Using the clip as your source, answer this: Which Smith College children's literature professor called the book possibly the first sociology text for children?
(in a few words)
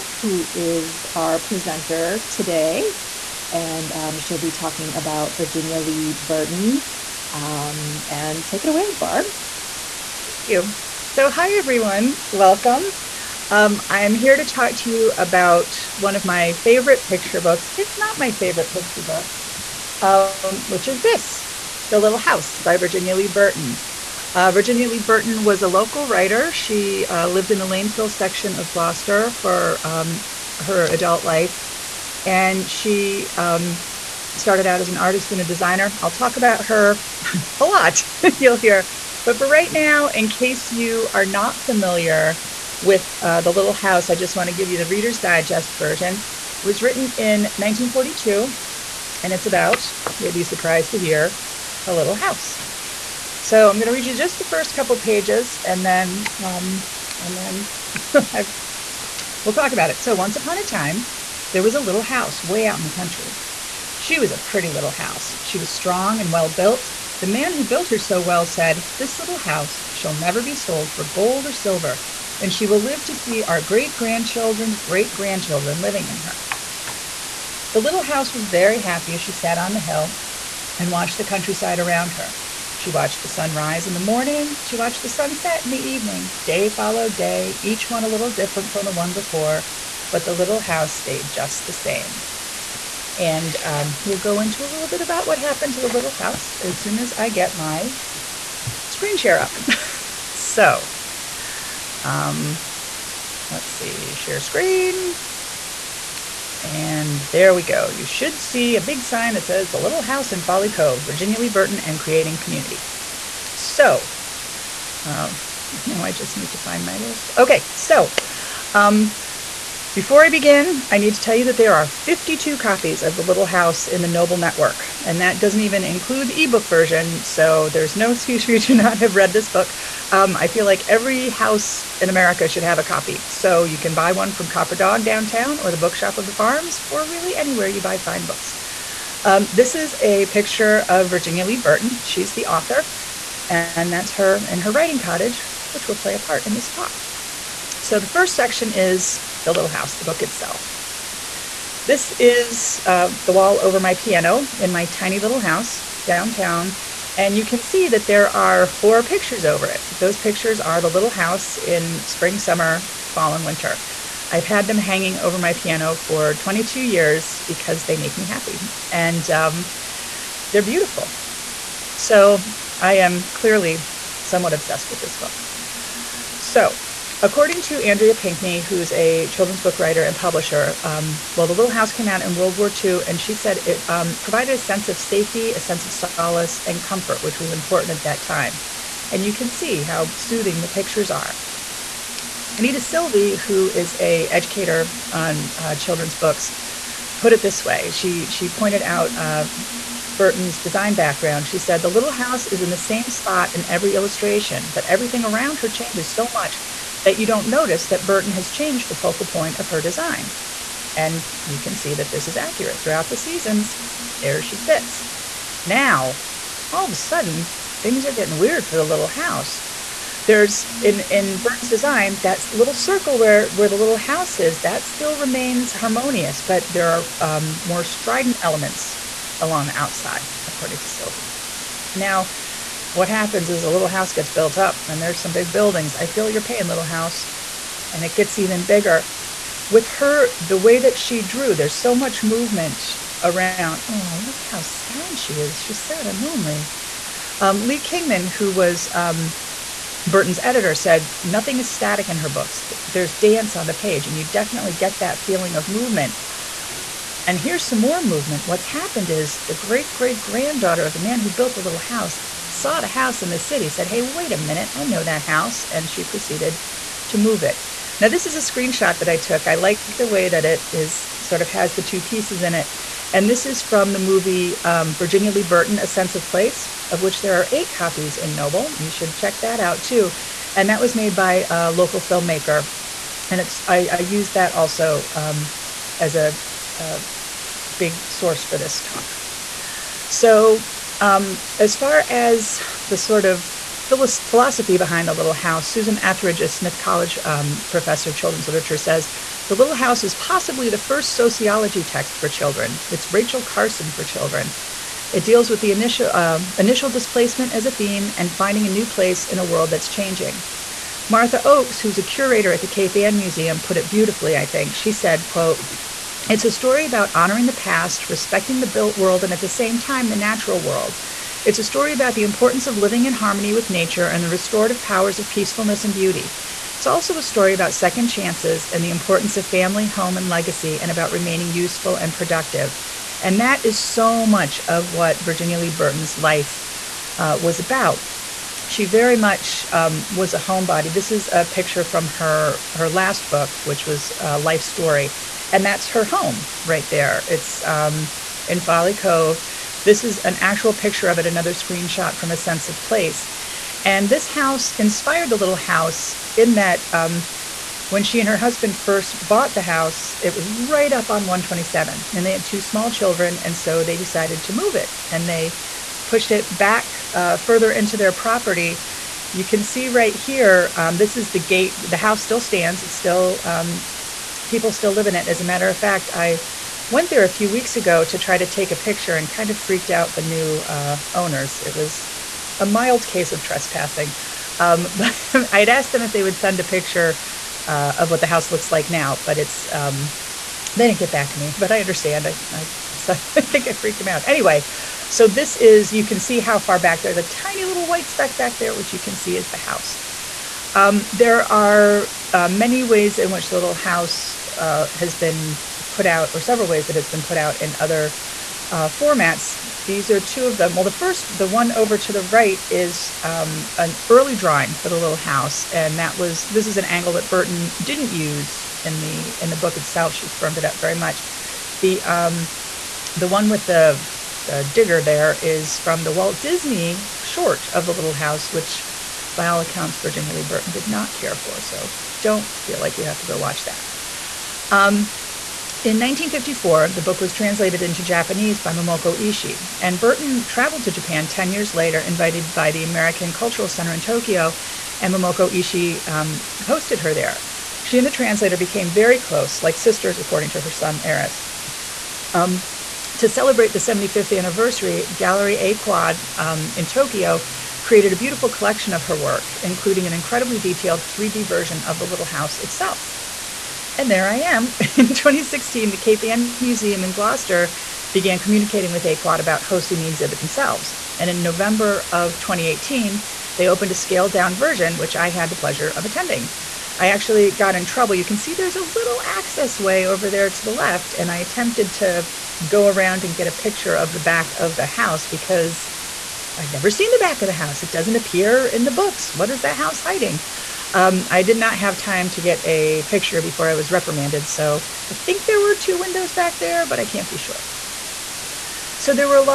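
Susan Etheridge.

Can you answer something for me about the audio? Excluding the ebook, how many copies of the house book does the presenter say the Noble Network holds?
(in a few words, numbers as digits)
52.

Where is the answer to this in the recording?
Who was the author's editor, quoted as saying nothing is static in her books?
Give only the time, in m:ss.
4:07.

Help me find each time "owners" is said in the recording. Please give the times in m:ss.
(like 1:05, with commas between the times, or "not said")
6:21.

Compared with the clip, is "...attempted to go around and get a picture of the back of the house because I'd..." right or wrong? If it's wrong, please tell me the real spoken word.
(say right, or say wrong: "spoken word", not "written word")
right.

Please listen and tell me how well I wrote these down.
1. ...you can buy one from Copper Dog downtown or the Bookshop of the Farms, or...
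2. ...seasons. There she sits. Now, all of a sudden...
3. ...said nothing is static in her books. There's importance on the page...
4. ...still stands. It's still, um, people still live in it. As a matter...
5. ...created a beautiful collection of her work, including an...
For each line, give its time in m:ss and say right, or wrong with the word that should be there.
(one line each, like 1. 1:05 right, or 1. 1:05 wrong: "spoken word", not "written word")
1. 2:13 right
2. 3:33 right
3. 4:10 wrong: "dance", not "importance"
4. 6:12 right
5. 7:37 right.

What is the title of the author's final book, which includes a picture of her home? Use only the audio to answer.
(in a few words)
Life Story.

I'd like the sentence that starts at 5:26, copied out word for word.
It's also a story about second chances and the importance of family, home, and legacy, and about remaining useful and productive.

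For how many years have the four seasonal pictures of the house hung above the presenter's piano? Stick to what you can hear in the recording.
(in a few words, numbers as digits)
22.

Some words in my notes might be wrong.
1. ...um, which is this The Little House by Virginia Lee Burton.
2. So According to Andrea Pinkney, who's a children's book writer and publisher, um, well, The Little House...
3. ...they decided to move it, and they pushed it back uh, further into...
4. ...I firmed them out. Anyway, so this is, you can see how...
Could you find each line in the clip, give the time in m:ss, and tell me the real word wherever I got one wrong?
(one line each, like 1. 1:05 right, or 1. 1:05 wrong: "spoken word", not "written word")
1. 0:20 right
2. 2:56 right
3. 6:03 right
4. 6:33 wrong: "freaked", not "firmed".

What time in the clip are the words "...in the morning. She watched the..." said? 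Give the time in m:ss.
1:23.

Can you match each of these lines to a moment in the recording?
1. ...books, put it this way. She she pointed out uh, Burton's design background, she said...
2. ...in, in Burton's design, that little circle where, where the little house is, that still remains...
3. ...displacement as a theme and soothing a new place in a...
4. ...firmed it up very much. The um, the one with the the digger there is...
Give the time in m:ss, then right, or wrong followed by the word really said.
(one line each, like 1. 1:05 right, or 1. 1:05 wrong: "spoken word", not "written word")
1. 3:16 right
2. 3:40 right
3. 5:06 wrong: "finding", not "soothing"
4. 7:00 right.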